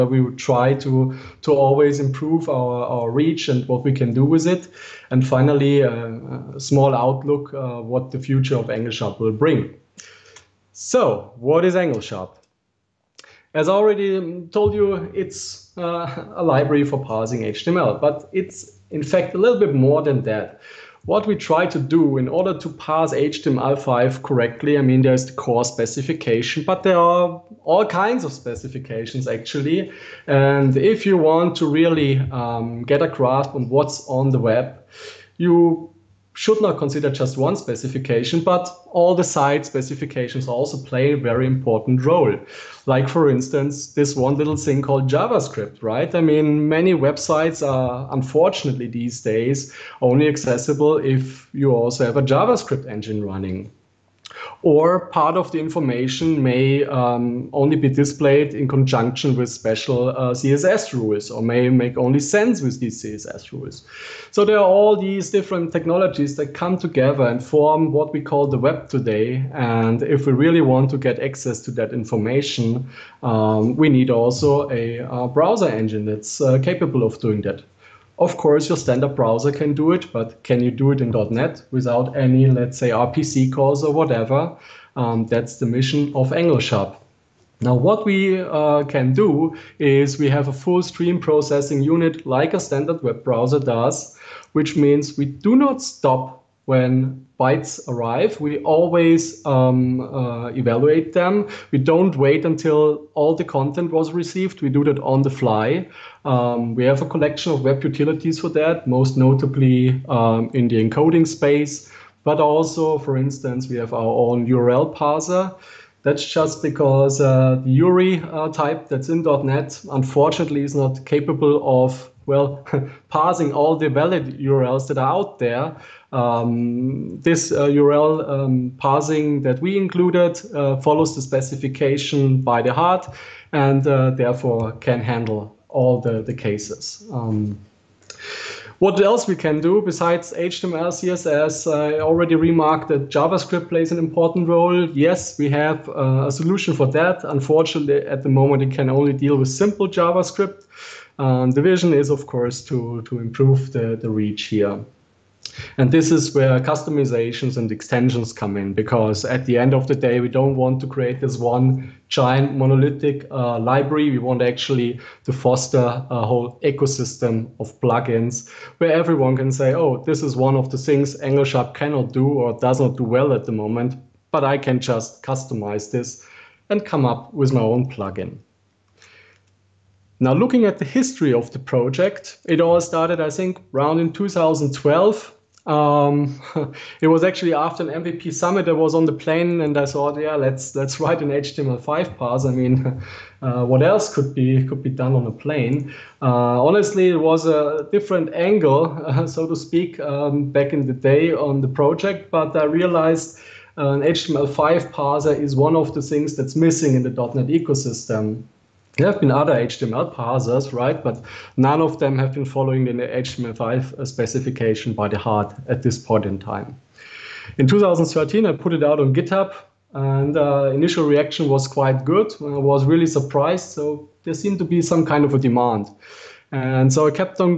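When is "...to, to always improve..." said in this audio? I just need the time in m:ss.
0:00.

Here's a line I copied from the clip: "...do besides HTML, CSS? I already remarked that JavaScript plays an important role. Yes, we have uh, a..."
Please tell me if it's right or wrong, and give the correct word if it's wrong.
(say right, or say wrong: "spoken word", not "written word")
right.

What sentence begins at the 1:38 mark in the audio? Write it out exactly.
We always um, uh, evaluate them.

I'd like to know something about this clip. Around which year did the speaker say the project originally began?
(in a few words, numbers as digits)
2012.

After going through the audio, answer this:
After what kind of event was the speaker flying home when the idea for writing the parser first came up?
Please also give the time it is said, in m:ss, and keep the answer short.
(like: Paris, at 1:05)
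MVP summit, at 3:08.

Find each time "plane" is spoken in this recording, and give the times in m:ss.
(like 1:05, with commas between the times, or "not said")
3:09, 3:15.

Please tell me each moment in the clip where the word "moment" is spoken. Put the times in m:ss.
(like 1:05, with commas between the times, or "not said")
2:28, 2:53.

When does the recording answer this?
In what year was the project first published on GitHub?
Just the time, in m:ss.
3:37.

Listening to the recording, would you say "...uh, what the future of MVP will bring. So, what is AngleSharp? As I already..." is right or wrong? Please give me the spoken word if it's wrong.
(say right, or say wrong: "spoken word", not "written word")
wrong: "AngleSharp", not "MVP".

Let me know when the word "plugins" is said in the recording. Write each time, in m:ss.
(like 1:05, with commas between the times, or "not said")
2:47, 2:57.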